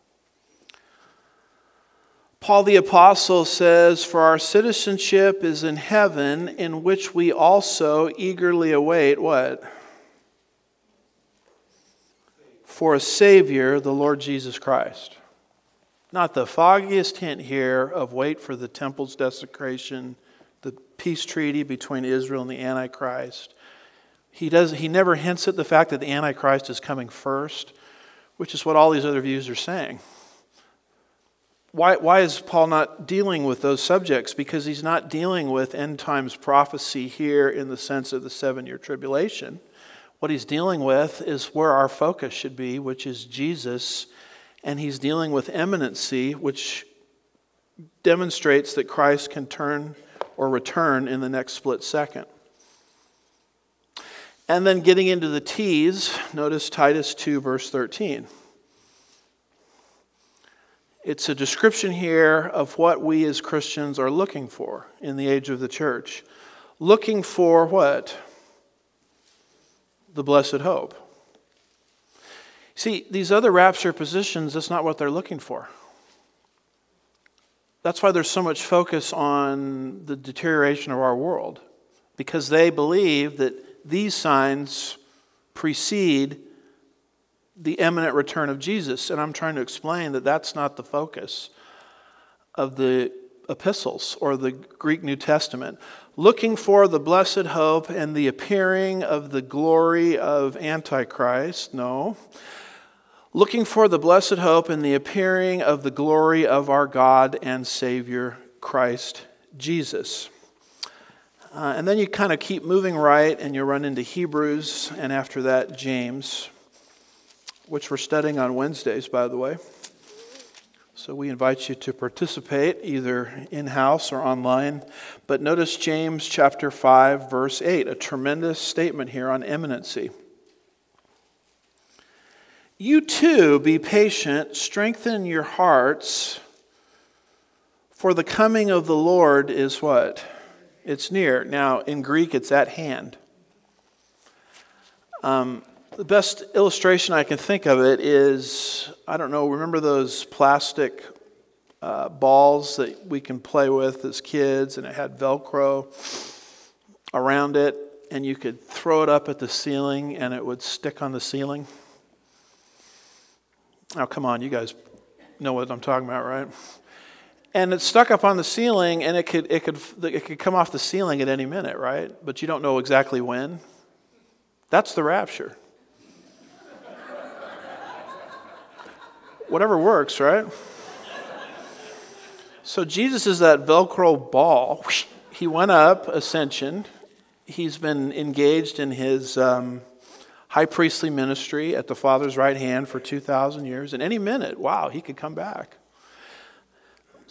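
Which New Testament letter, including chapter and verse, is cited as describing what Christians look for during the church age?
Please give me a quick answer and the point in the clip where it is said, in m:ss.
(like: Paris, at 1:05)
Titus 2:13, at 0:56.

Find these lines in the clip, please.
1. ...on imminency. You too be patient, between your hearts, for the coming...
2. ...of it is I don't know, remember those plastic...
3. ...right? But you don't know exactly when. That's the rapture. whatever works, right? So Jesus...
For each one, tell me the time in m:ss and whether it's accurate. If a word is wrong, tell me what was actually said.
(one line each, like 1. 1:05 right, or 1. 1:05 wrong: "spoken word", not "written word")
1. 2:09 wrong: "strengthen", not "between"
2. 2:27 right
3. 2:51 right.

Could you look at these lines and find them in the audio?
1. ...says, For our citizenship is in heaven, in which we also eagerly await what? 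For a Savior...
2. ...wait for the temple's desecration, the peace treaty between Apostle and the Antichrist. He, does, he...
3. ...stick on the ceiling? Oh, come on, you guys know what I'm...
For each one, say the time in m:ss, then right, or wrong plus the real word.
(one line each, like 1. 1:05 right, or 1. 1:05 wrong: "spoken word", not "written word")
1. 0:03 right
2. 0:18 wrong: "Israel", not "Apostle"
3. 2:40 right.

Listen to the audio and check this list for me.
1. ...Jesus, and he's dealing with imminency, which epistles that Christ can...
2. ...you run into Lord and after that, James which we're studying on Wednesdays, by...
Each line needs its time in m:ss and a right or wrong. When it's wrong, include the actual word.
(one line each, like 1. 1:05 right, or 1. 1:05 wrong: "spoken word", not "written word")
1. 0:43 wrong: "demonstrates", not "epistles"
2. 1:53 wrong: "Hebrews", not "Lord".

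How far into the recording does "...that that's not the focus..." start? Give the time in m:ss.
1:30.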